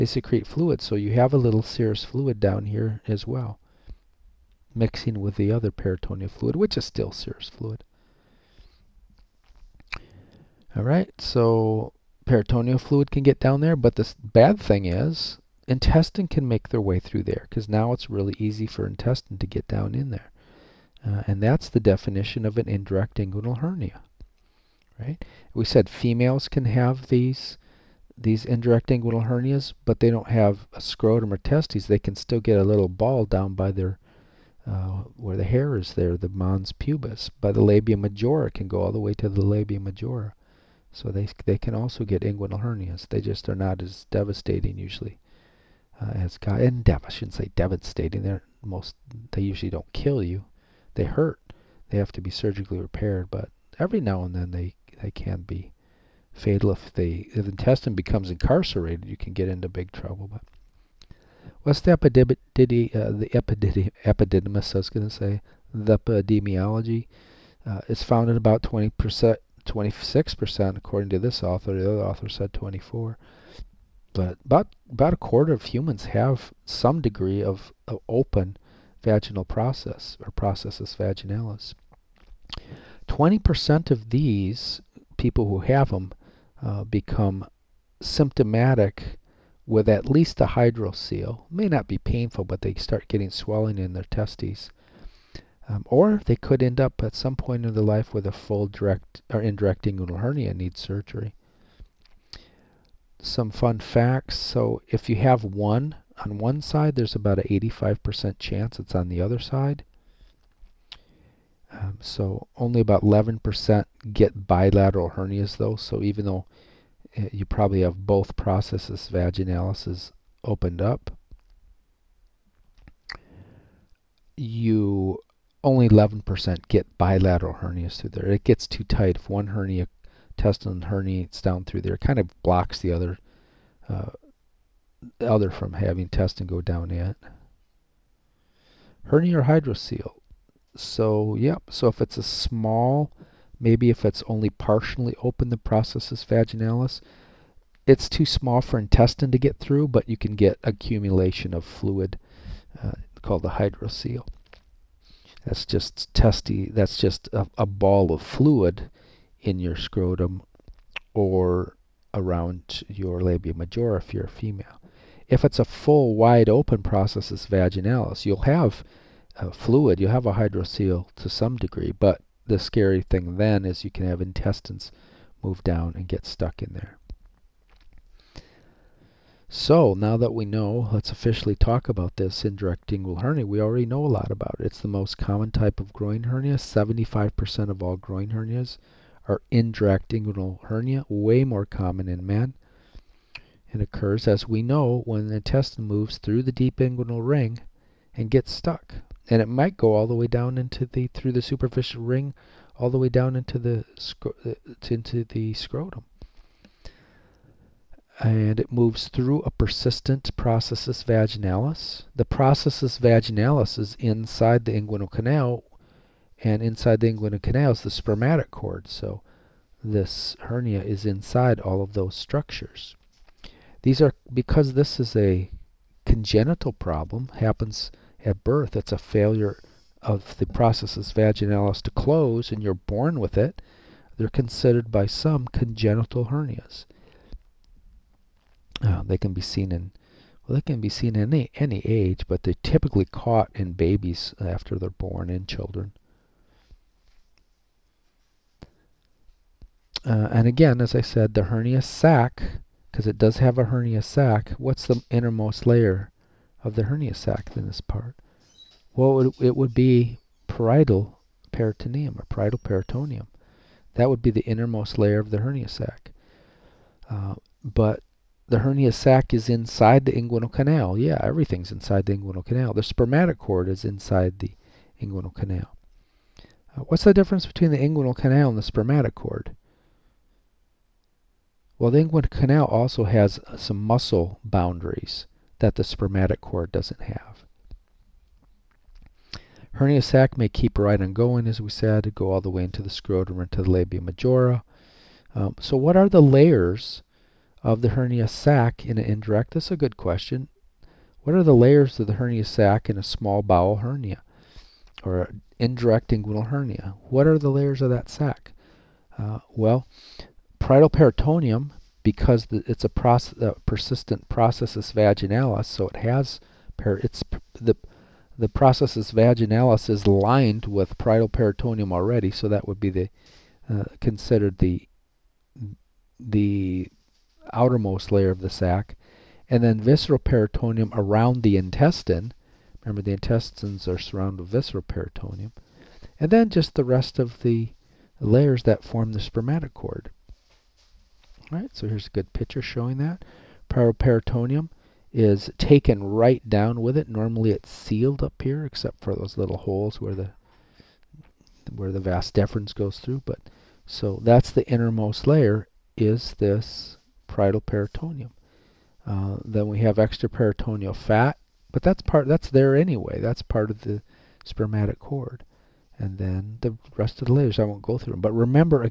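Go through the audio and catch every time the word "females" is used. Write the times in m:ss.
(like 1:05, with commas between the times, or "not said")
0:25, 2:44.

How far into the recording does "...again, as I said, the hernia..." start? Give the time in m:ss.
4:10.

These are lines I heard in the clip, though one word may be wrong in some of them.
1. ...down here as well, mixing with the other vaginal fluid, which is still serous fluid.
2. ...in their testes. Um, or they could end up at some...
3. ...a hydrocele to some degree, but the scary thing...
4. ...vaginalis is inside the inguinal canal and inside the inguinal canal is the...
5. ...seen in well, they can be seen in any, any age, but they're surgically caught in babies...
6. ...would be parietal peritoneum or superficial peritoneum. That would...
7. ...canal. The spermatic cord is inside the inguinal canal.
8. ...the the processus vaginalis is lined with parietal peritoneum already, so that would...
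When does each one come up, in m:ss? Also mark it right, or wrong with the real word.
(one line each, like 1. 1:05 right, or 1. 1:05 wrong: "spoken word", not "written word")
1. 0:02 wrong: "peritoneal", not "vaginal"
2. 1:33 right
3. 2:50 right
4. 3:32 right
5. 3:59 wrong: "typically", not "surgically"
6. 4:19 wrong: "parietal", not "superficial"
7. 4:32 right
8. 5:17 right.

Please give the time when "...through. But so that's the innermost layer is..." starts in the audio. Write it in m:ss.
5:52.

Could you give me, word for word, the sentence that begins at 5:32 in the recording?
Remember, the intestines are surrounded with visceral peritoneum, and then just the rest of the layers that form the spermatic cord.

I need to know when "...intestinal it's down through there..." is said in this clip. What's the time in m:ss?
2:10.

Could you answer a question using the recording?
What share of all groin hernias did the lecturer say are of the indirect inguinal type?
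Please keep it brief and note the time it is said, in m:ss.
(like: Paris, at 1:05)
75%, at 3:06.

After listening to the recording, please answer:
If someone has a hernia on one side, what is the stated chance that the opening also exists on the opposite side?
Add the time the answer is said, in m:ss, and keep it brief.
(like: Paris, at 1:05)
85%, at 1:47.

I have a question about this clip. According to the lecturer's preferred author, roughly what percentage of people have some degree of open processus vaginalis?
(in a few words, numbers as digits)
26%.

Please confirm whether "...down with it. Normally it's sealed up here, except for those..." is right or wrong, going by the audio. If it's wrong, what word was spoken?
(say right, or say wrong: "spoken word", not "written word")
right.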